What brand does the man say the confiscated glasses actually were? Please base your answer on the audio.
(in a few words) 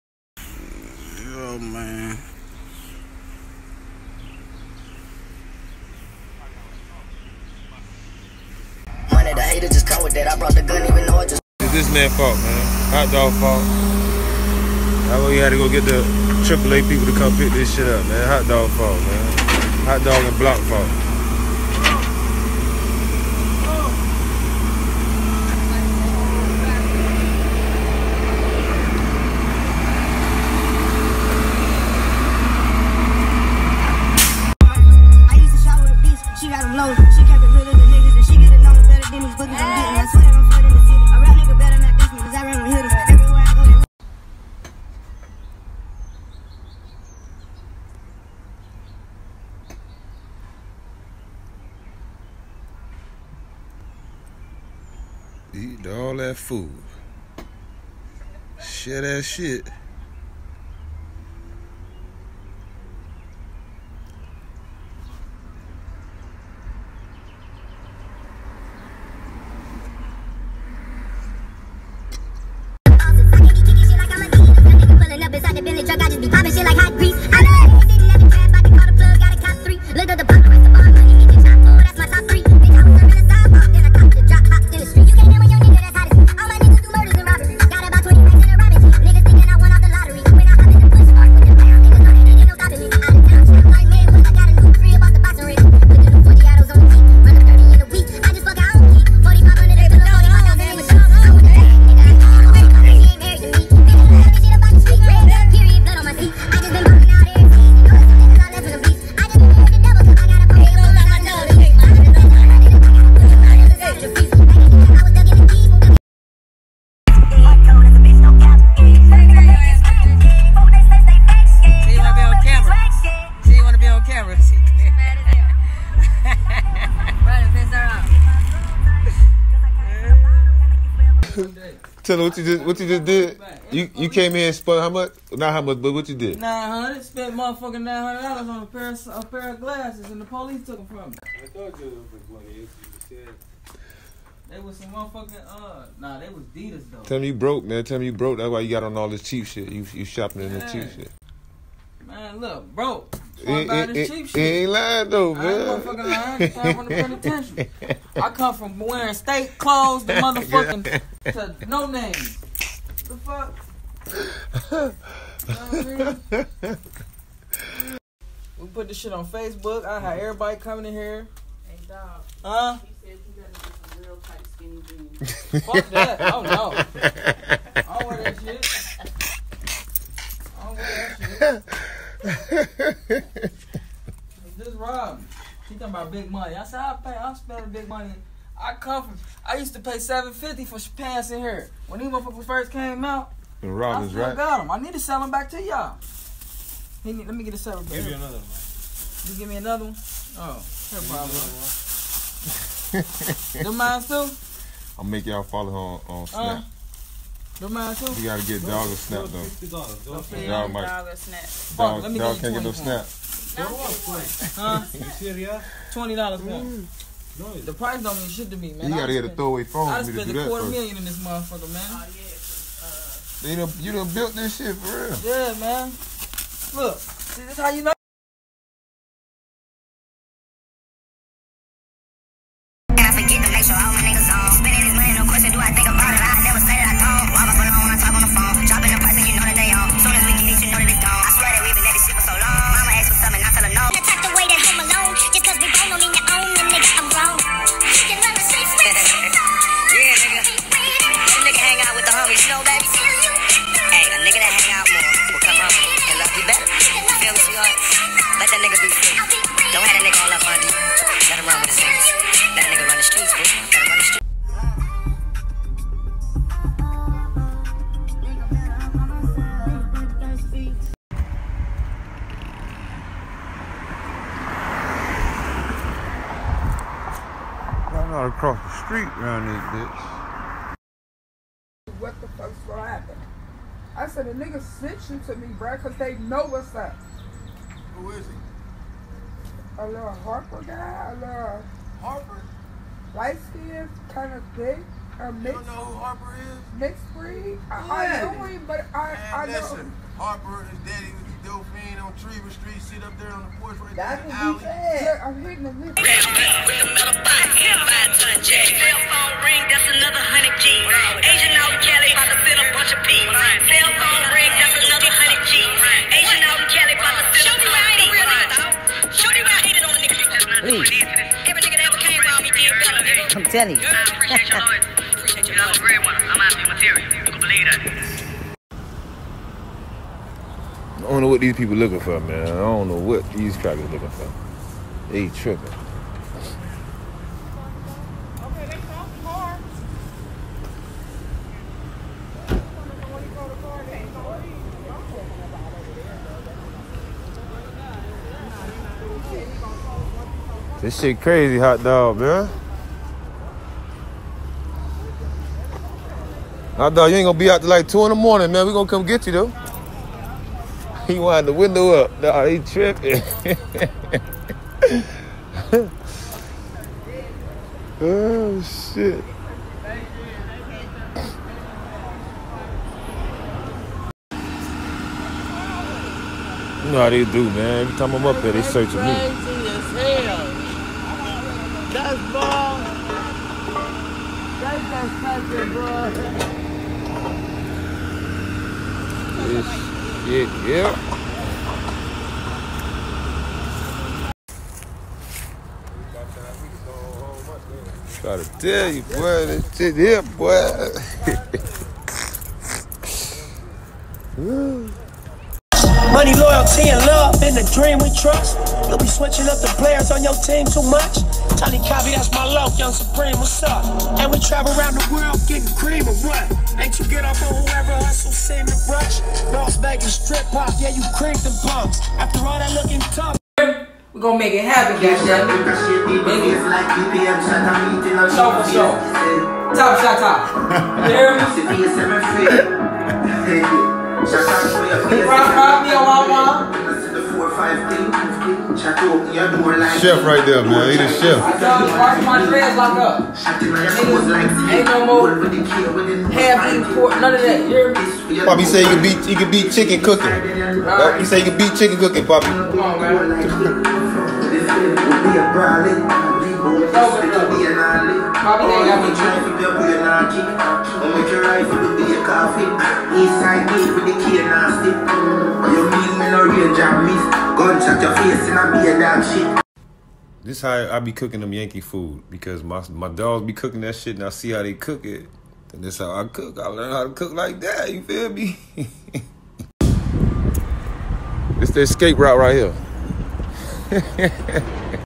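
Adidas.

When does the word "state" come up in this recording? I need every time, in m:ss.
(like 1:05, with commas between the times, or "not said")
2:39.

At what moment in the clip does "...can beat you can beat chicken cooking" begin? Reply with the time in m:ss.
7:28.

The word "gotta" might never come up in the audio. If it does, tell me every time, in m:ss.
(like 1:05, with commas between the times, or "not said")
3:28, 3:38.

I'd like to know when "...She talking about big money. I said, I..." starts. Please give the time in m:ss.
3:05.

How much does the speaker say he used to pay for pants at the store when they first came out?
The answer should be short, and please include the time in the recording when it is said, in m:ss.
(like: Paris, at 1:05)
$750, at 3:09.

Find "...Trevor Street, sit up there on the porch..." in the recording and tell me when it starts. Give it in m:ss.
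5:02.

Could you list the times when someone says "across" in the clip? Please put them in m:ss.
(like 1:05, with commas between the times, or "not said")
4:38.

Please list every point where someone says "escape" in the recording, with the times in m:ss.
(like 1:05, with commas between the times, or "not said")
8:01.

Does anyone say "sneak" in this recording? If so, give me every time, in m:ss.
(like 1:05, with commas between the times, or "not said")
not said.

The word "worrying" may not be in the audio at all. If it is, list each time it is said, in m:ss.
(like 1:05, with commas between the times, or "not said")
not said.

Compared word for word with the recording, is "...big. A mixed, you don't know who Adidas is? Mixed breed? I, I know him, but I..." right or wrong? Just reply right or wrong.
wrong.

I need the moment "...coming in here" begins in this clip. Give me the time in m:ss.
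2:50.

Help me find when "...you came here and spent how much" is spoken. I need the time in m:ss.
2:13.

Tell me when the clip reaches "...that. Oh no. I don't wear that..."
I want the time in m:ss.
2:55.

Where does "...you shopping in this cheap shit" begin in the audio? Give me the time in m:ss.
2:29.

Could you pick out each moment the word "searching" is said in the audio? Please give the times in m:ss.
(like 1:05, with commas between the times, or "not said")
6:18.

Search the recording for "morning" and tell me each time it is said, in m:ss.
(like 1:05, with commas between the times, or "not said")
5:58.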